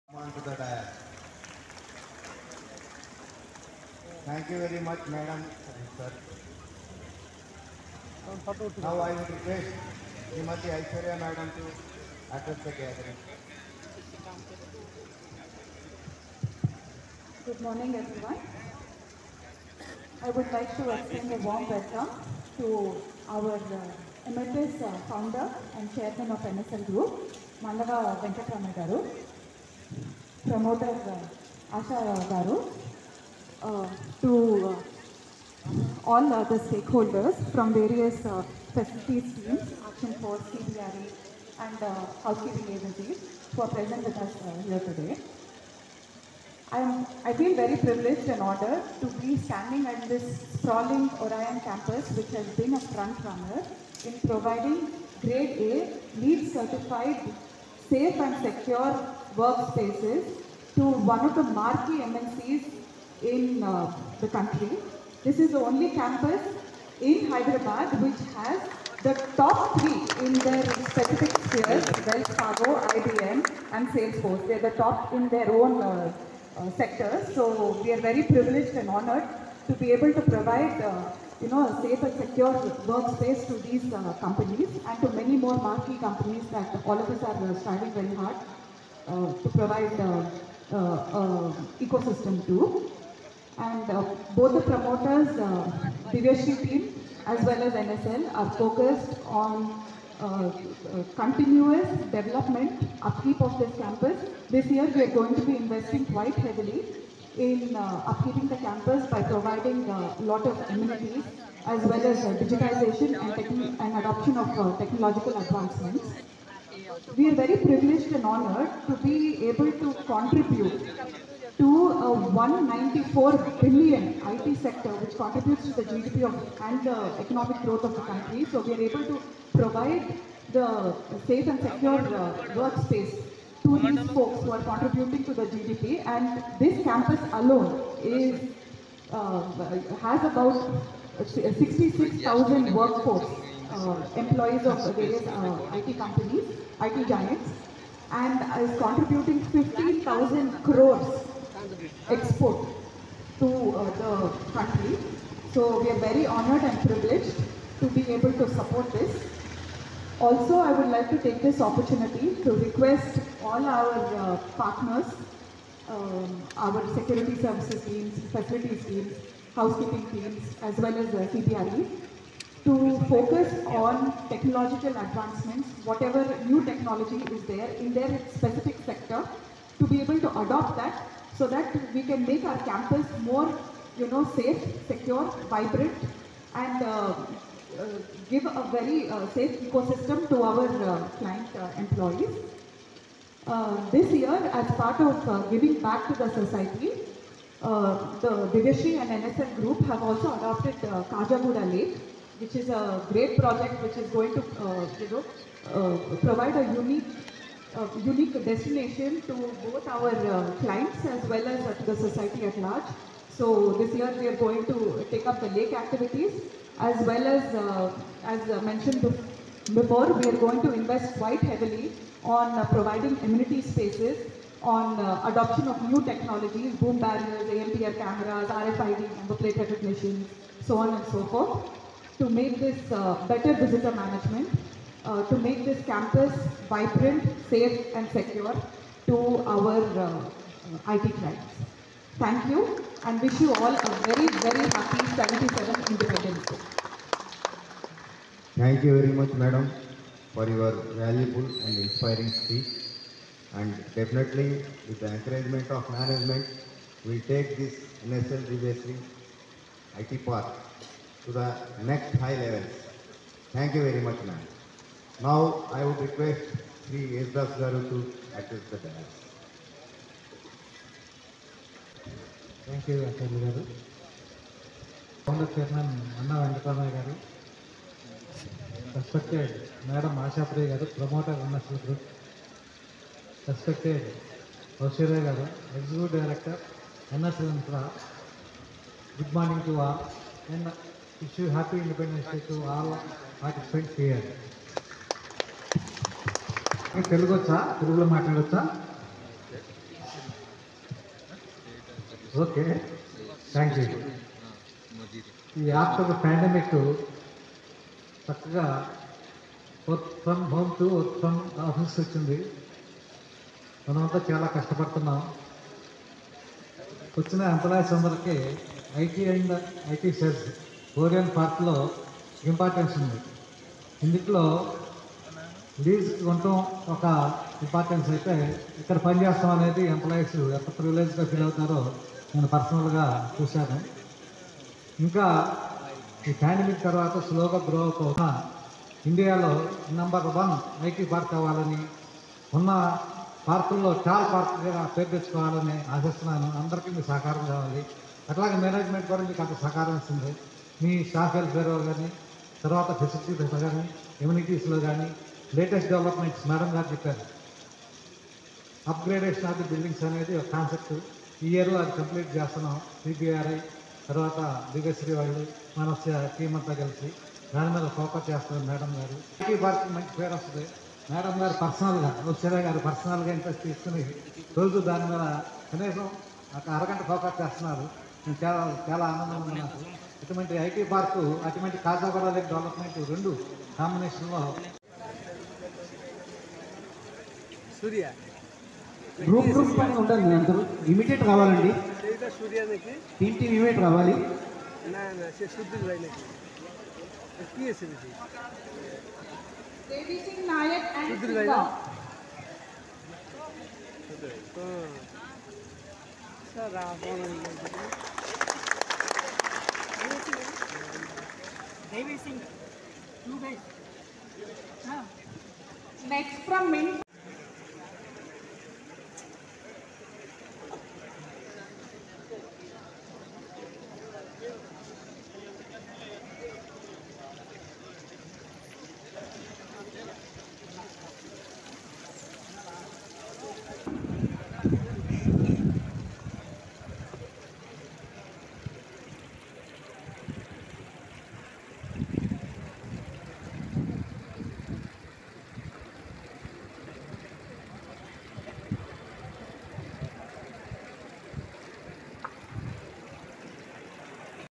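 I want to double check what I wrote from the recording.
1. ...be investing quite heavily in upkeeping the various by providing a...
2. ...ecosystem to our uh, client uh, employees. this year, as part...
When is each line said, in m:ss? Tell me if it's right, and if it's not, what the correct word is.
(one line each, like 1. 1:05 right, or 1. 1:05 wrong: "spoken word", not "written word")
1. 1:45 wrong: "campus", not "various"
2. 3:09 right.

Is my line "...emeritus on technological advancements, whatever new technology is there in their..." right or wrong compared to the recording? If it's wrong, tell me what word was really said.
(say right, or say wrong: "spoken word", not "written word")
wrong: "focus", not "emeritus".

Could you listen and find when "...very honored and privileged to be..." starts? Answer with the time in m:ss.
2:35.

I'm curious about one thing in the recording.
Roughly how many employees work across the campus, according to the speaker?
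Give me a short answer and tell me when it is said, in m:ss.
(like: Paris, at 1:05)
66,000, at 2:21.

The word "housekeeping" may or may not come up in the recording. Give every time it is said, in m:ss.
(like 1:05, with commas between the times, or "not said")
0:42, 2:49.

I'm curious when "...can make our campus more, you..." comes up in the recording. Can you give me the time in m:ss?
3:02.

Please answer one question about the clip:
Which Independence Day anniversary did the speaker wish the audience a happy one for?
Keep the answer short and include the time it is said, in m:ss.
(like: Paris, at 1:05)
77th, at 4:05.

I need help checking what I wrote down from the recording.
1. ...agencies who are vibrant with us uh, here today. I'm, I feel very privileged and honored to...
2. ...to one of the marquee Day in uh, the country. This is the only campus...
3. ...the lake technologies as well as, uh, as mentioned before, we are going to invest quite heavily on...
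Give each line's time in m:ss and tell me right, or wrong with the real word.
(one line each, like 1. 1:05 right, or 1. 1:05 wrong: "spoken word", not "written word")
1. 0:42 wrong: "present", not "vibrant"
2. 1:00 wrong: "MNCs", not "Day"
3. 3:35 wrong: "activities", not "technologies".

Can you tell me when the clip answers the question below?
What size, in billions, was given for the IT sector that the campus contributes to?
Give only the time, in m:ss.
2:02.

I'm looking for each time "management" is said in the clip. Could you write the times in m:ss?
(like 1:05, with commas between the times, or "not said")
3:53, 4:15.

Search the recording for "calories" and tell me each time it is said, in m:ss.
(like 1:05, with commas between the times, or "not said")
not said.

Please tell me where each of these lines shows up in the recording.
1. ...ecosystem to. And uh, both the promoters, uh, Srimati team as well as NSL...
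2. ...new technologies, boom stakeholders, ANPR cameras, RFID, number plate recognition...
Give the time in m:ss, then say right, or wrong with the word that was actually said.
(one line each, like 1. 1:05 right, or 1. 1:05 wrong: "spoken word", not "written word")
1. 1:31 wrong: "Divyasree", not "Srimati"
2. 3:45 wrong: "barriers", not "stakeholders".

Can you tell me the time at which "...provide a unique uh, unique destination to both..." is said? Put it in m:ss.
3:26.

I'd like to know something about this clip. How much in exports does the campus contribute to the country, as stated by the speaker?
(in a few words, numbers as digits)
15,000 crores.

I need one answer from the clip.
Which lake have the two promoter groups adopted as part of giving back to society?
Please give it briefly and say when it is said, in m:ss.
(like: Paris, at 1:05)
Khajaguda Lake, at 3:21.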